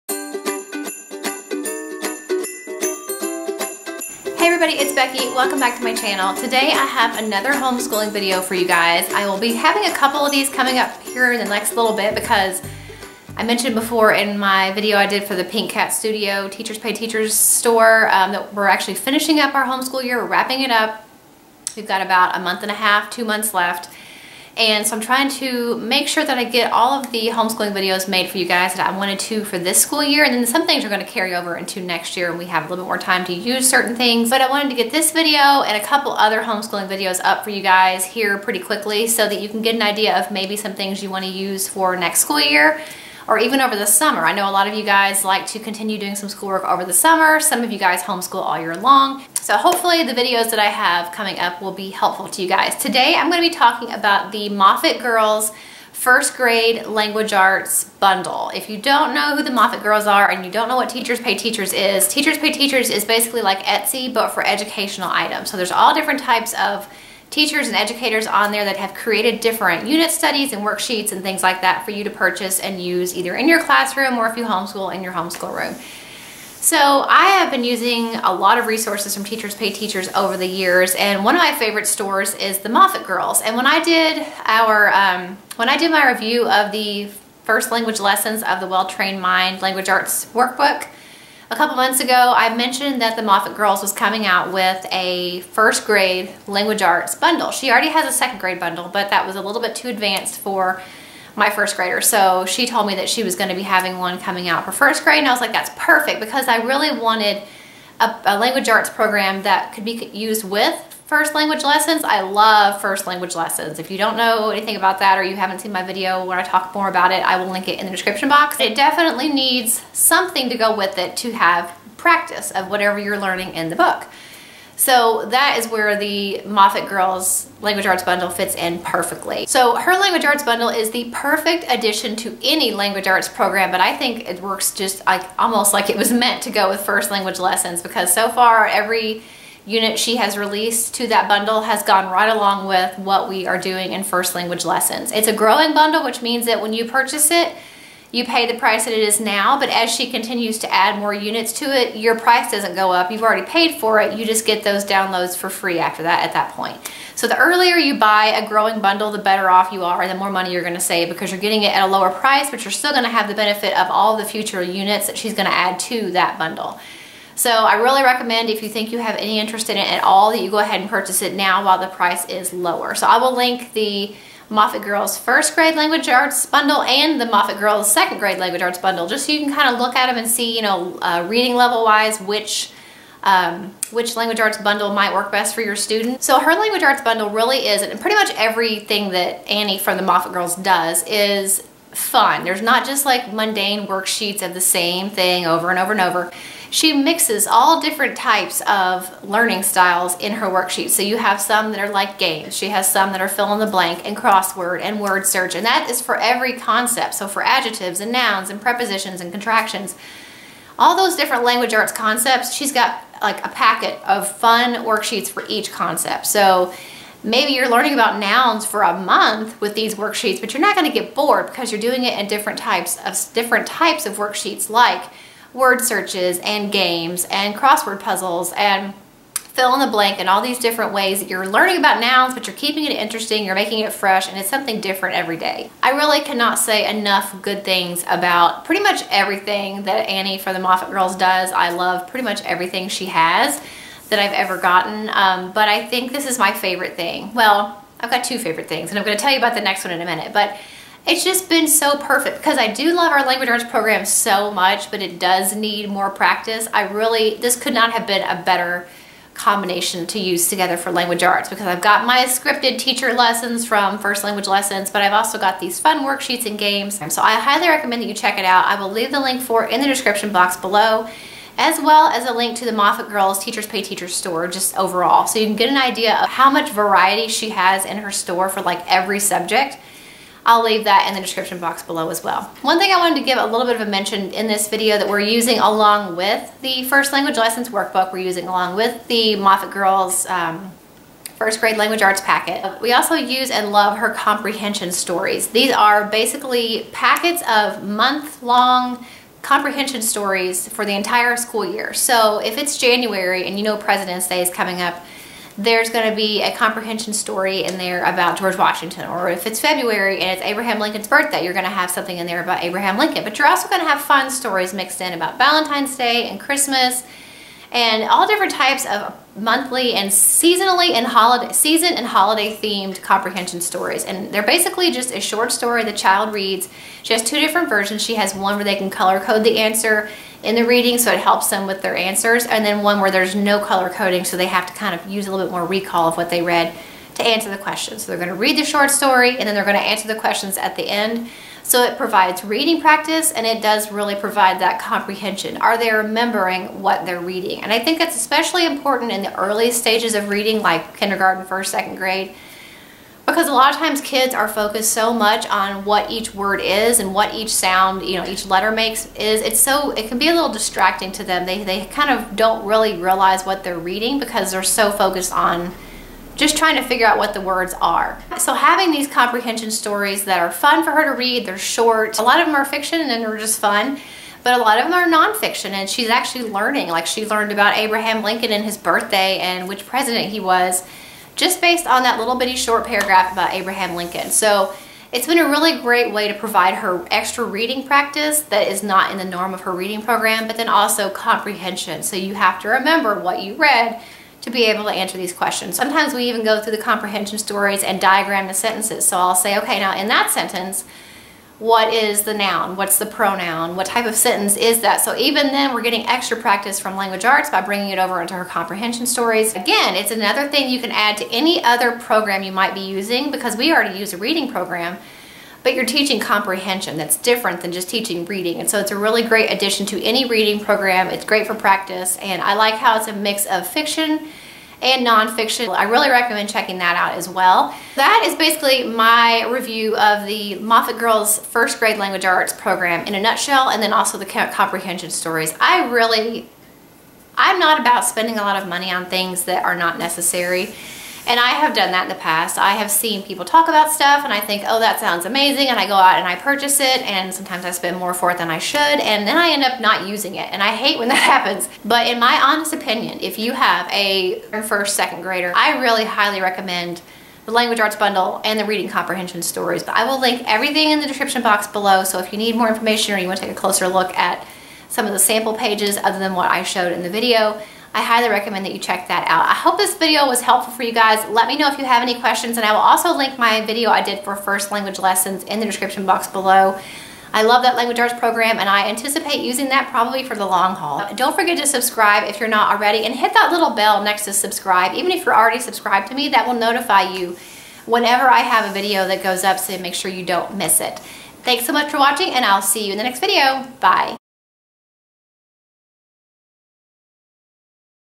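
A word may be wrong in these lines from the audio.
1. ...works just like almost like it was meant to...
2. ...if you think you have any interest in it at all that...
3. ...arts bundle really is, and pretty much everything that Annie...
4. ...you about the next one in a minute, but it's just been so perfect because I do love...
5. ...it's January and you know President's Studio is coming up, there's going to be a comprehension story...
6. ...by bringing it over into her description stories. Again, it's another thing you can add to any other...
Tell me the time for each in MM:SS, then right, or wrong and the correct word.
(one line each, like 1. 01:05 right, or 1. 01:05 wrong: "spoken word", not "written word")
1. 02:14 right
2. 02:48 right
3. 03:06 right
4. 04:09 right
5. 05:02 wrong: "Day", not "Studio"
6. 06:47 wrong: "comprehension", not "description".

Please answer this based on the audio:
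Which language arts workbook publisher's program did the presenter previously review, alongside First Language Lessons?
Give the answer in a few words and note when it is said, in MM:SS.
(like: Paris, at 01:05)
Well-Trained Mind, at 01:28.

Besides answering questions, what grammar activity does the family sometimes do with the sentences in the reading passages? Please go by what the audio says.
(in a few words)
diagram the sentences.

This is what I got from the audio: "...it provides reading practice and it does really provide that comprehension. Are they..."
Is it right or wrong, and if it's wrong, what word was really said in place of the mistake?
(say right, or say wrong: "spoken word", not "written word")
right.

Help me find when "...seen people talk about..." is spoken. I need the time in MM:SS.
07:22.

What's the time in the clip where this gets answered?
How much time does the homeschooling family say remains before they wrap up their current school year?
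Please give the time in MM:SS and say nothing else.
00:22.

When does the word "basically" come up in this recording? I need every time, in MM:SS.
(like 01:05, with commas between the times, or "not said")
01:03, 04:56, 05:24, 07:08.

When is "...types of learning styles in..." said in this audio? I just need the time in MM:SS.
03:18.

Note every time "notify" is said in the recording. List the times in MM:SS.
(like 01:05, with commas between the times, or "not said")
08:06.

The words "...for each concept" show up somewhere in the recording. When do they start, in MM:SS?
03:35.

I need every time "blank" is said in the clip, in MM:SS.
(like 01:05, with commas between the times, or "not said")
03:23, 03:49.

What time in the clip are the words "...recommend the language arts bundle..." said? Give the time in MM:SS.
07:36.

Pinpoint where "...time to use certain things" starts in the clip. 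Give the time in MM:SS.
00:32.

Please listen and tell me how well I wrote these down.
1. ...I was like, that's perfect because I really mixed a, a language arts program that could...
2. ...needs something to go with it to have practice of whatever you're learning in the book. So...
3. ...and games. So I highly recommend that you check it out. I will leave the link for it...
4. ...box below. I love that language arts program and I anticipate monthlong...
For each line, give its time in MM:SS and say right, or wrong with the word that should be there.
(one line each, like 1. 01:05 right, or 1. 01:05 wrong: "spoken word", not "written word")
1. 01:45 wrong: "wanted", not "mixed"
2. 01:59 right
3. 04:26 right
4. 07:56 wrong: "using", not "monthlong".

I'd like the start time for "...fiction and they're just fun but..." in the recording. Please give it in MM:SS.
06:12.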